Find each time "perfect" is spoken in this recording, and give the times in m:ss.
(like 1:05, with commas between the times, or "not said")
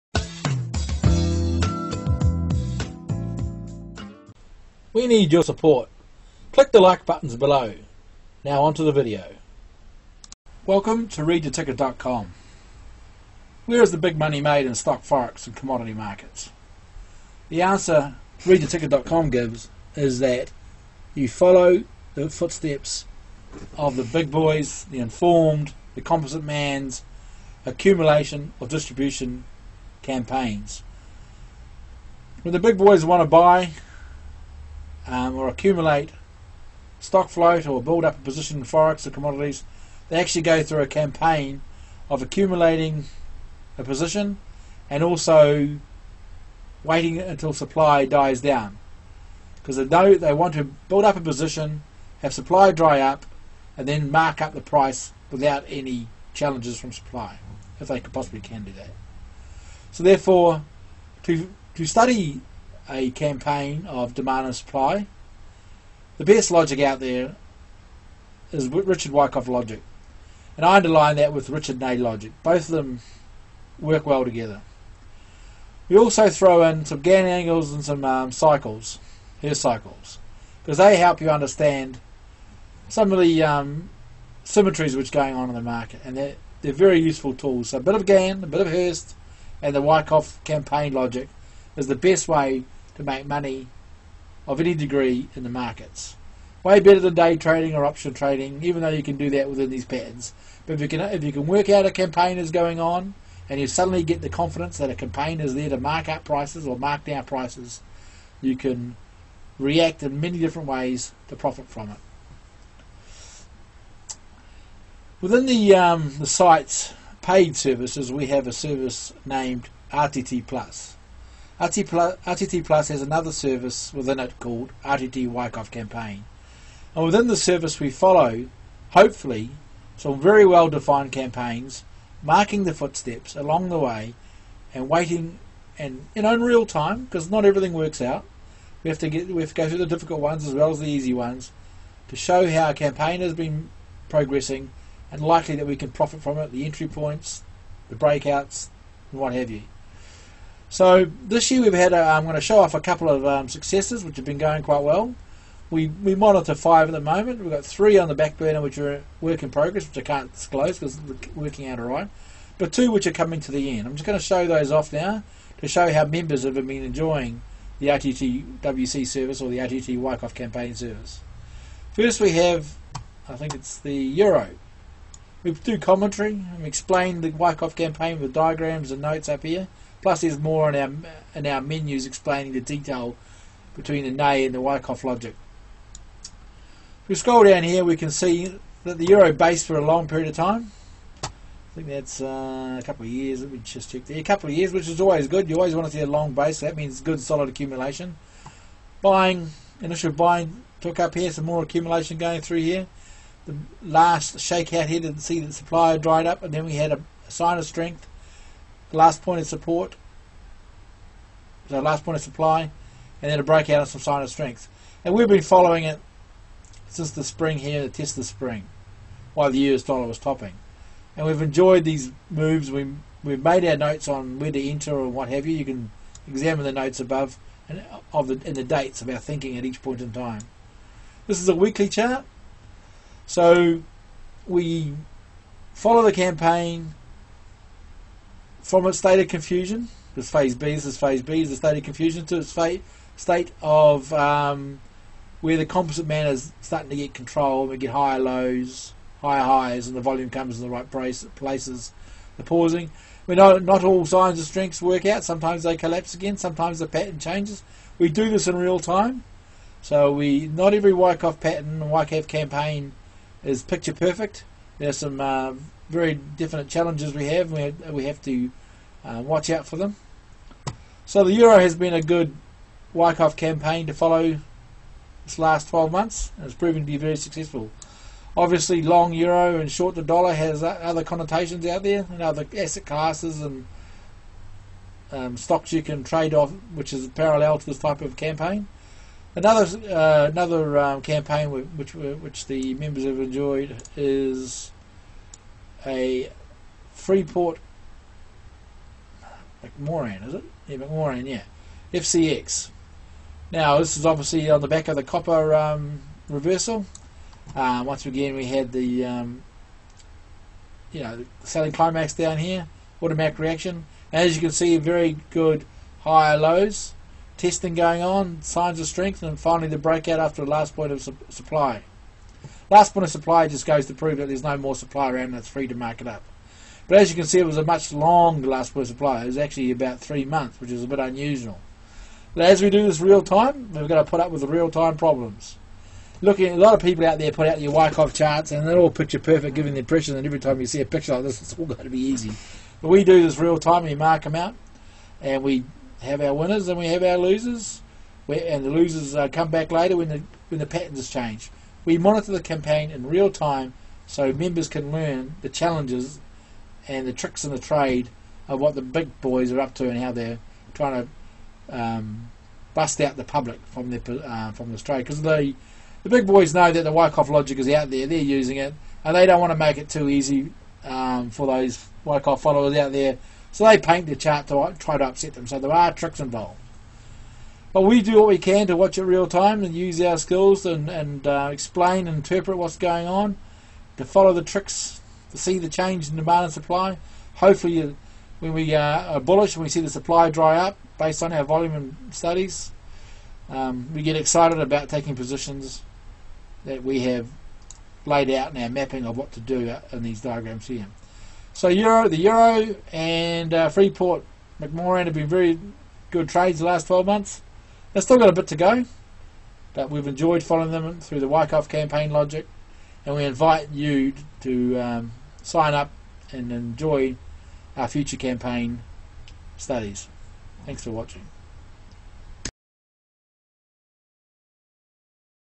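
4:23, 5:39.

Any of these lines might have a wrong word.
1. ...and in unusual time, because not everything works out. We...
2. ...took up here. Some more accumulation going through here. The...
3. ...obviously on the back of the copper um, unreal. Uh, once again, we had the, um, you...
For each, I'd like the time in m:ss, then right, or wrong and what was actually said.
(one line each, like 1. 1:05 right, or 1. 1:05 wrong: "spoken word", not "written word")
1. 2:15 wrong: "unreal", not "unusual"
2. 3:20 right
3. 5:04 wrong: "reversal", not "unreal".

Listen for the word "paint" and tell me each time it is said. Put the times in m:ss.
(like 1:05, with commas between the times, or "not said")
6:13.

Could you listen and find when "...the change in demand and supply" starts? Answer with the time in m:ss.
6:25.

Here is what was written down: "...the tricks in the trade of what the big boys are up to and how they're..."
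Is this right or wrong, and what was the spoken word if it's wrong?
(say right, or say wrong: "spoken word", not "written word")
right.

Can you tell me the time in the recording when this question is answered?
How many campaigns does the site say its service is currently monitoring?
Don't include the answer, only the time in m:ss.
2:36.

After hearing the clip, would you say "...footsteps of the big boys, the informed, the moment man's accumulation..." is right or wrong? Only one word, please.
wrong.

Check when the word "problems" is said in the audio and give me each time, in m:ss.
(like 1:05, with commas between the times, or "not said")
5:34.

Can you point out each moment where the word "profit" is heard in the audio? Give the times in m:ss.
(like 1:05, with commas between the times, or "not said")
1:51, 2:25.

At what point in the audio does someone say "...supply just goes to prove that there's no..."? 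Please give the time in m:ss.
5:23.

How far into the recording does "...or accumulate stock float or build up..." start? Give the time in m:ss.
0:35.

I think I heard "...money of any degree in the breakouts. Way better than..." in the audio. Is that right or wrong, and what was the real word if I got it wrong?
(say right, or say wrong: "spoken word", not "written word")
wrong: "markets", not "breakouts".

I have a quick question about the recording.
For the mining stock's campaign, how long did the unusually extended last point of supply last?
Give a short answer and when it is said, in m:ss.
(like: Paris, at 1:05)
About 3 months, at 5:29.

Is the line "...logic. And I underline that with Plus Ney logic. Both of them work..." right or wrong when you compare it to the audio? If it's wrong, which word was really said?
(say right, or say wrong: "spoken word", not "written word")
wrong: "Richard", not "Plus".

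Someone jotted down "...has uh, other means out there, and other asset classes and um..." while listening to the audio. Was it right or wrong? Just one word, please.
wrong.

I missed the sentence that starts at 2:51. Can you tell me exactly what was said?
First we have, I think it's the Euro.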